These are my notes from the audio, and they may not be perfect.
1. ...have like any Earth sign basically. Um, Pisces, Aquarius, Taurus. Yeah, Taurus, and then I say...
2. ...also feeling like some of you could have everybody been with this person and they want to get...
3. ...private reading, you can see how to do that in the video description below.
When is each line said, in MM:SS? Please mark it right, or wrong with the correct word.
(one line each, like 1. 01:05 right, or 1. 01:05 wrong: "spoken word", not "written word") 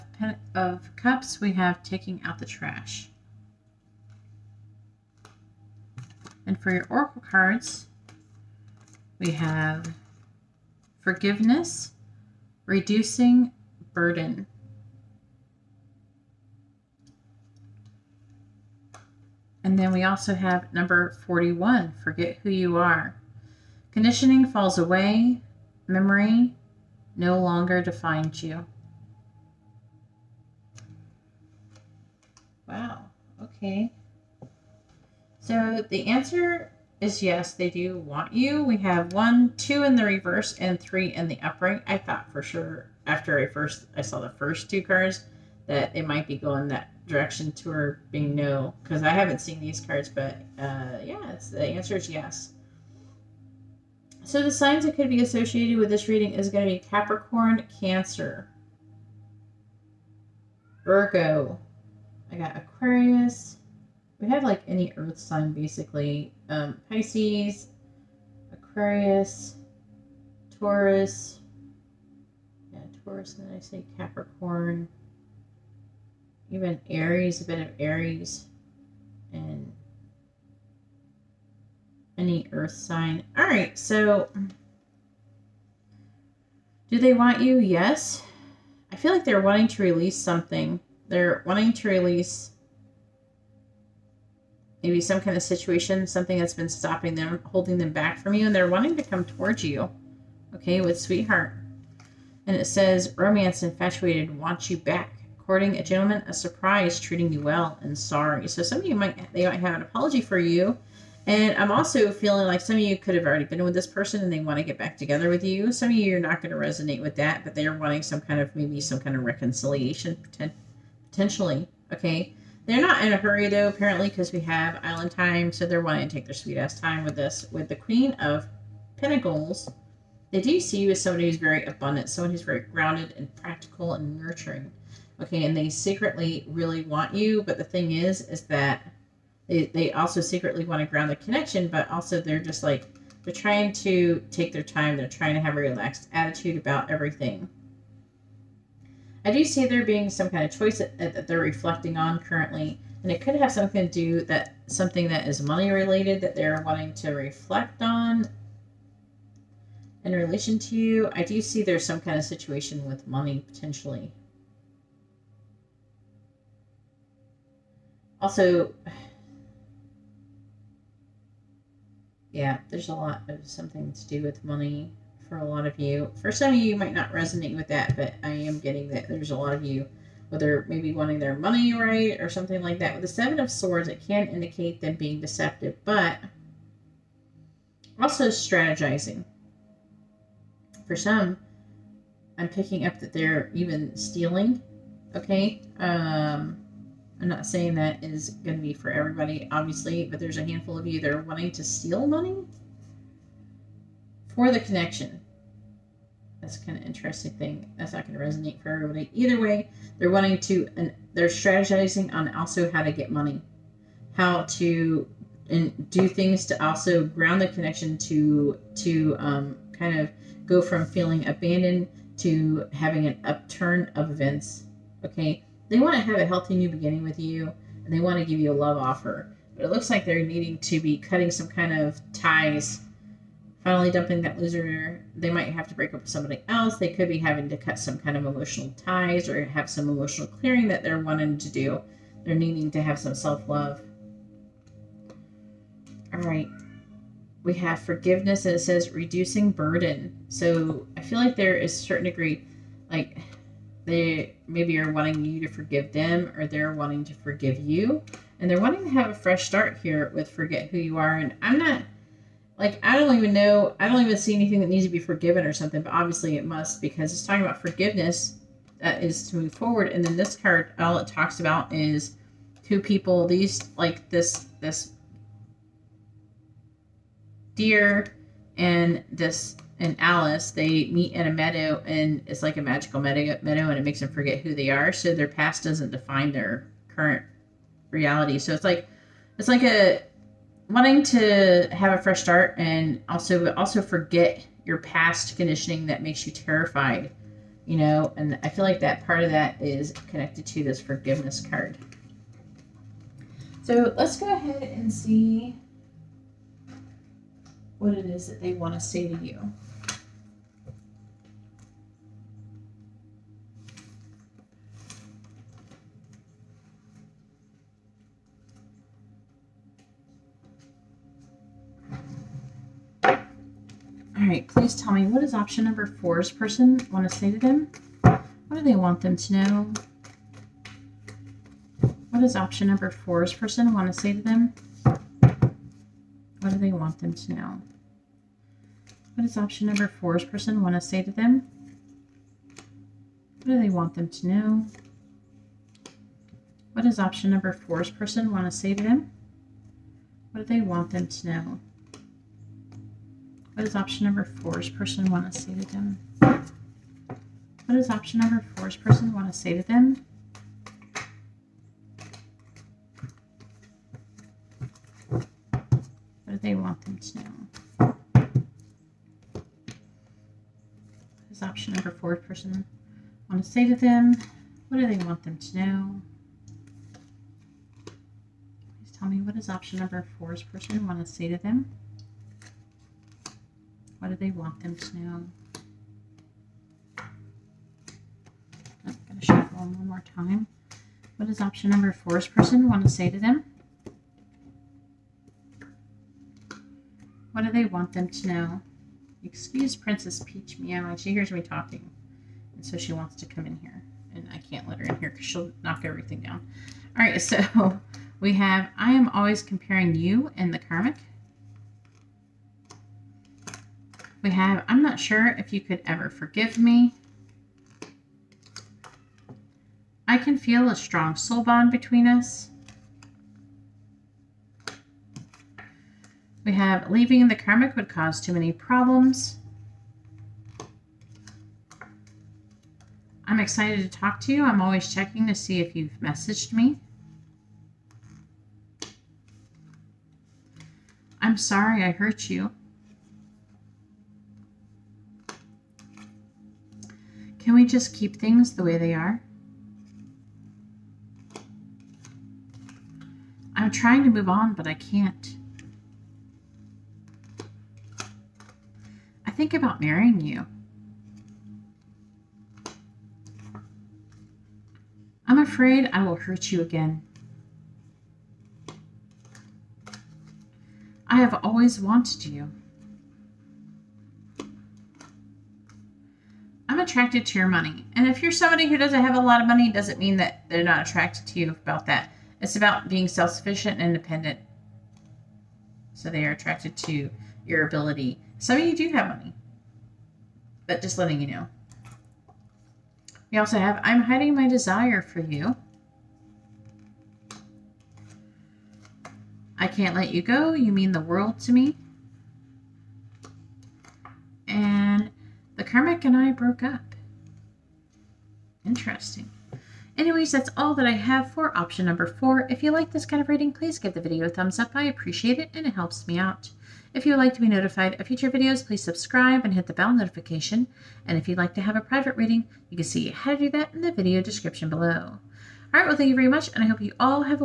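1. 01:04 right
2. 01:51 wrong: "already", not "everybody"
3. 08:41 right.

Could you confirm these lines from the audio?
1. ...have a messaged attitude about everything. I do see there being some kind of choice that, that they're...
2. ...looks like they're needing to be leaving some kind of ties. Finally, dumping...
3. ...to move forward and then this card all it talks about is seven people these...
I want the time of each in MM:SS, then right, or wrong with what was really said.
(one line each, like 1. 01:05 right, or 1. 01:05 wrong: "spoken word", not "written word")
1. 02:25 wrong: "relaxed", not "messaged"
2. 03:49 wrong: "cutting", not "leaving"
3. 04:29 wrong: "two", not "seven".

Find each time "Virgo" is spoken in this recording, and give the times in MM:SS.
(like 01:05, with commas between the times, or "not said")
01:00.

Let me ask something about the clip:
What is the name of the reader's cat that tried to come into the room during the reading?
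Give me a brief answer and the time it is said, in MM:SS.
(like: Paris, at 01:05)
Princess Peach, at 06:39.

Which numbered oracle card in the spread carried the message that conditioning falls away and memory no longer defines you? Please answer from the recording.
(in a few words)
41.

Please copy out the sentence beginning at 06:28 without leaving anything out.
I'm going to shuffle one more time.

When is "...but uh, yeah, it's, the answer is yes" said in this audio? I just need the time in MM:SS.
00:50.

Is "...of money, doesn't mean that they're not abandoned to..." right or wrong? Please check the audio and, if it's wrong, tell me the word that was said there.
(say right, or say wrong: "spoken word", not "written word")
wrong: "attracted", not "abandoned".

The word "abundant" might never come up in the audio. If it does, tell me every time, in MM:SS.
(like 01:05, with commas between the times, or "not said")
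02:11.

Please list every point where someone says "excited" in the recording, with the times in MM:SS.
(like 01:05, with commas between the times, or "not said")
07:13.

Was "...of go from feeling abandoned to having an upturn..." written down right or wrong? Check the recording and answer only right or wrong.
right.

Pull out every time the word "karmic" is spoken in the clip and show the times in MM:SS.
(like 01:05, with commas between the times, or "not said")
06:50, 07:07.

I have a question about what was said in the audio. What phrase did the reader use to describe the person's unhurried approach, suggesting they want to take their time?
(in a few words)
Island time.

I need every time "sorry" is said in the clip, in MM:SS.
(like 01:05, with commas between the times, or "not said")
01:47, 07:21.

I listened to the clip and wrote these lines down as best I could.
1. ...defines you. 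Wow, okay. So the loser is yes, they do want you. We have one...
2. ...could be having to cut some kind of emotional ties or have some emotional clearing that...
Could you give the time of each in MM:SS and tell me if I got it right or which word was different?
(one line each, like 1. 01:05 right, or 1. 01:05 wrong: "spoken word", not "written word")
1. 00:27 wrong: "answer", not "loser"
2. 03:56 right.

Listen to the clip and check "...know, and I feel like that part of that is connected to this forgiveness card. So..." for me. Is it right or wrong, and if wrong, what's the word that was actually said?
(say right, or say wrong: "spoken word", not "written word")
right.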